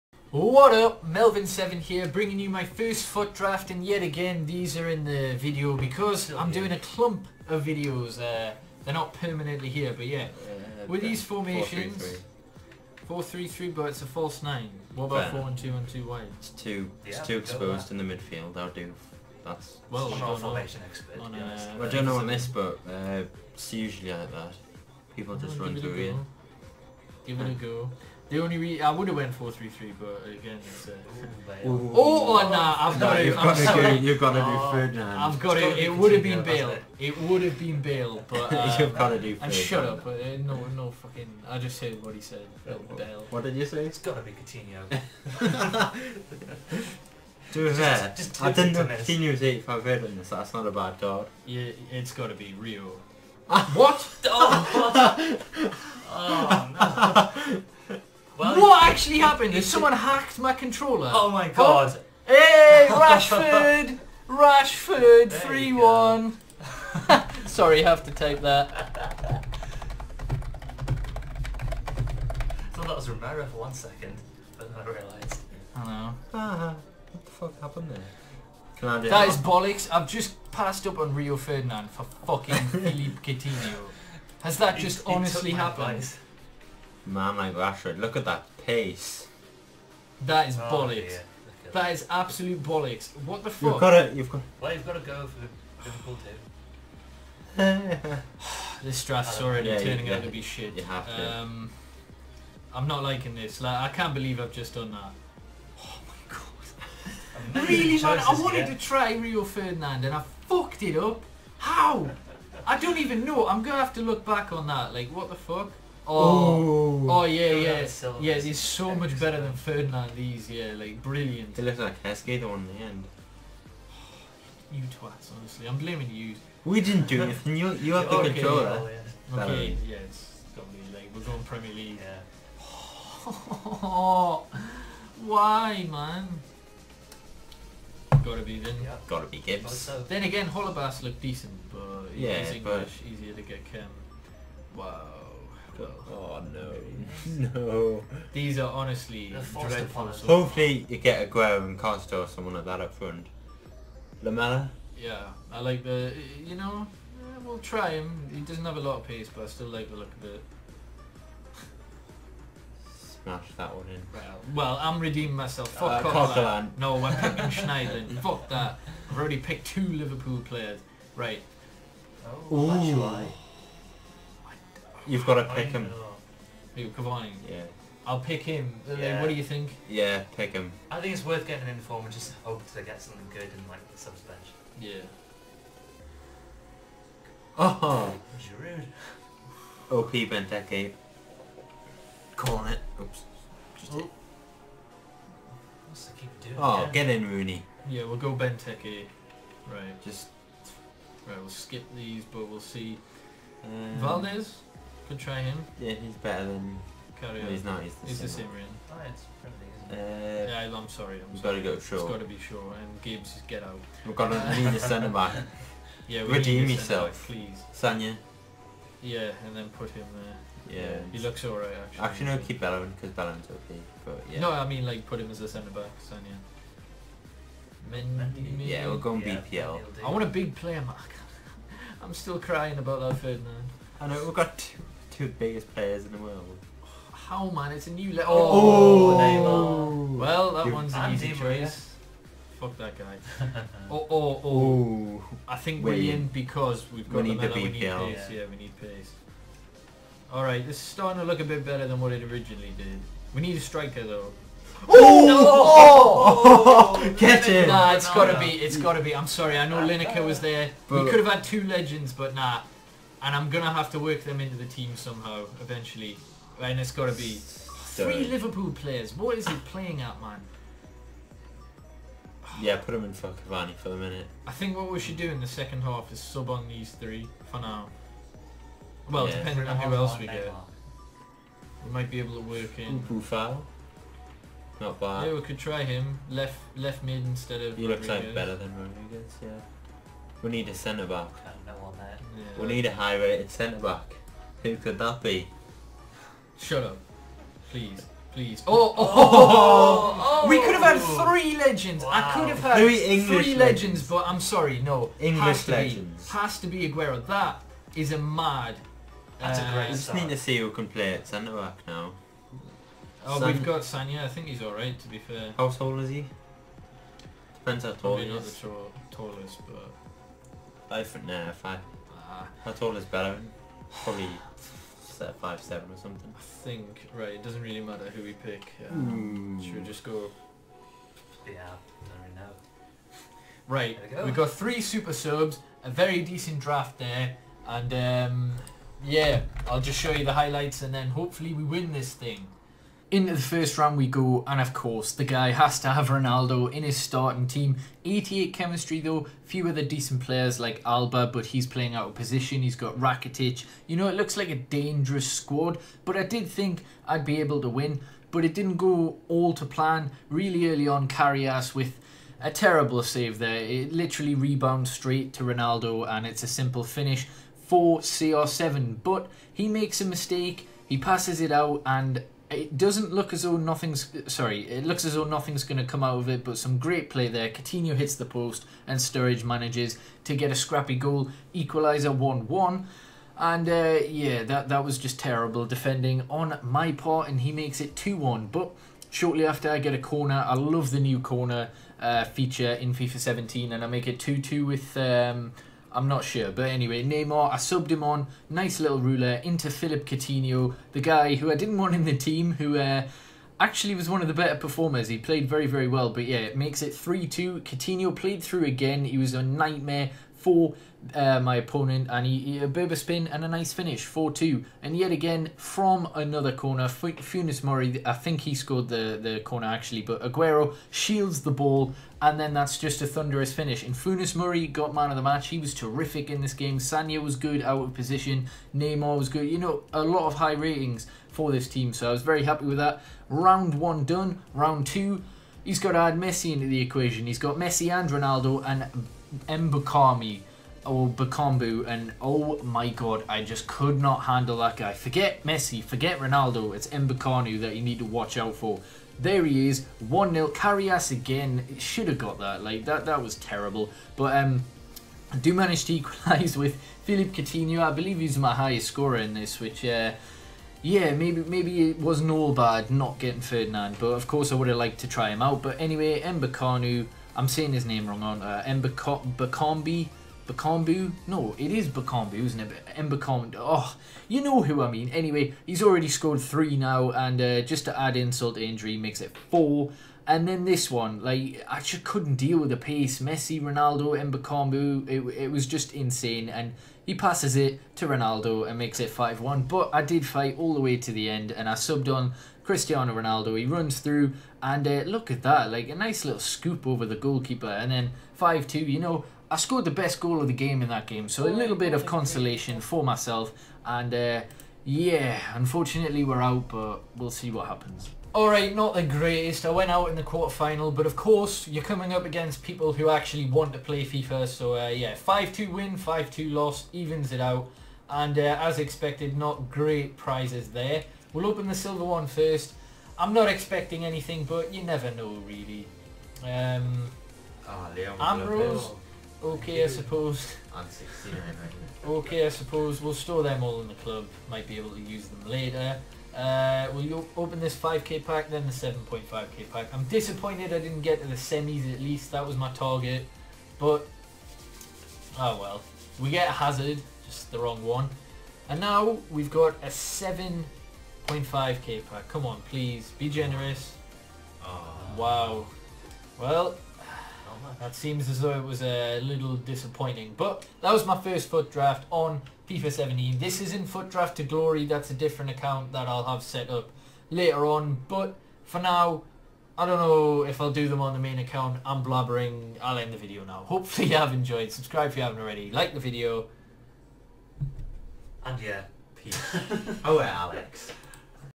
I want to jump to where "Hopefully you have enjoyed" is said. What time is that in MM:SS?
09:33.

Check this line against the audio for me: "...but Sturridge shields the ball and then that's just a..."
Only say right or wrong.
wrong.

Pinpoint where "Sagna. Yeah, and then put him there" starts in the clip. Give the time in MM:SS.
03:37.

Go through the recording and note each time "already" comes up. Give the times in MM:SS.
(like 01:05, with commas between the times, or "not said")
01:39, 02:49, 07:55, 09:35.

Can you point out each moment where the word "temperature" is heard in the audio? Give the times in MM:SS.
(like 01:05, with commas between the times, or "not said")
not said.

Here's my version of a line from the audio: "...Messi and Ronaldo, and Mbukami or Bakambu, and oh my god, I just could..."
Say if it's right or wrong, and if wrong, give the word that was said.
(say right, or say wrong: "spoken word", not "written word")
right.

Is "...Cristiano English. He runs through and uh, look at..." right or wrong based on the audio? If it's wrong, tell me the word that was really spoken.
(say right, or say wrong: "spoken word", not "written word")
wrong: "Ronaldo", not "English".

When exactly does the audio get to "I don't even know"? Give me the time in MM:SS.
01:52.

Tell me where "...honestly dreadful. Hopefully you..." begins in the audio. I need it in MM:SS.
02:28.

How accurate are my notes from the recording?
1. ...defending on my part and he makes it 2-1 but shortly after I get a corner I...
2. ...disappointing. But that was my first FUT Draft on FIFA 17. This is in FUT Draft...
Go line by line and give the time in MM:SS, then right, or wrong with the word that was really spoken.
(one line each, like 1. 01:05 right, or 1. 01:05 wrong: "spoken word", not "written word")
1. 06:25 right
2. 09:19 right.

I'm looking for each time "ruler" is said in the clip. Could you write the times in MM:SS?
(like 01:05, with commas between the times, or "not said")
06:38.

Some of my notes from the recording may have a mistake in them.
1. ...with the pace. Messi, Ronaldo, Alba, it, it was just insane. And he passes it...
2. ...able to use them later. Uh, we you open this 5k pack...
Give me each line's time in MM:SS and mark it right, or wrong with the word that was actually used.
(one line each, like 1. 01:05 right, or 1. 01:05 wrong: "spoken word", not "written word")
1. 08:02 wrong: "Mbakamu", not "Alba"
2. 08:54 right.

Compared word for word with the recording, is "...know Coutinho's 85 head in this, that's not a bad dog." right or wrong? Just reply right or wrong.
right.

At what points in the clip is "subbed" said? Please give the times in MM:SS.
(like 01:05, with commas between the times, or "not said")
06:37, 08:11.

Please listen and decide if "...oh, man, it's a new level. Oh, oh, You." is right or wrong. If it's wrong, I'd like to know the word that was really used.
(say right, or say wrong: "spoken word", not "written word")
wrong: "Neymar", not "You".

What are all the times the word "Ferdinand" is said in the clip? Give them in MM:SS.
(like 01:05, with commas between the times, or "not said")
00:34, 00:39, 01:21, 01:49, 01:59, 03:53, 07:43.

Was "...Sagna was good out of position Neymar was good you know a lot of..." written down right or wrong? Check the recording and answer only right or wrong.
right.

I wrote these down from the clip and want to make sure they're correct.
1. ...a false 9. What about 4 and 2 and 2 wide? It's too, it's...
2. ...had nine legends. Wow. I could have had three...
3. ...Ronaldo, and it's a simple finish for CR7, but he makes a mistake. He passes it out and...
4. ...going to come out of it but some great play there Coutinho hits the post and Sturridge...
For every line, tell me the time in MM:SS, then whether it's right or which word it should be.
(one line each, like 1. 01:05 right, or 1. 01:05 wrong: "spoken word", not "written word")
1. 00:14 right
2. 05:00 wrong: "three", not "nine"
3. 06:05 right
4. 06:15 right.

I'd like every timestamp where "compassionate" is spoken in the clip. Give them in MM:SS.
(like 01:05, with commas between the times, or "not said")
not said.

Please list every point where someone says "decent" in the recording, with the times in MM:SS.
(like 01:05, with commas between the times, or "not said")
02:21, 05:36, 05:49.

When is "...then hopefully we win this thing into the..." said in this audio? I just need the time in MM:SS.
05:40.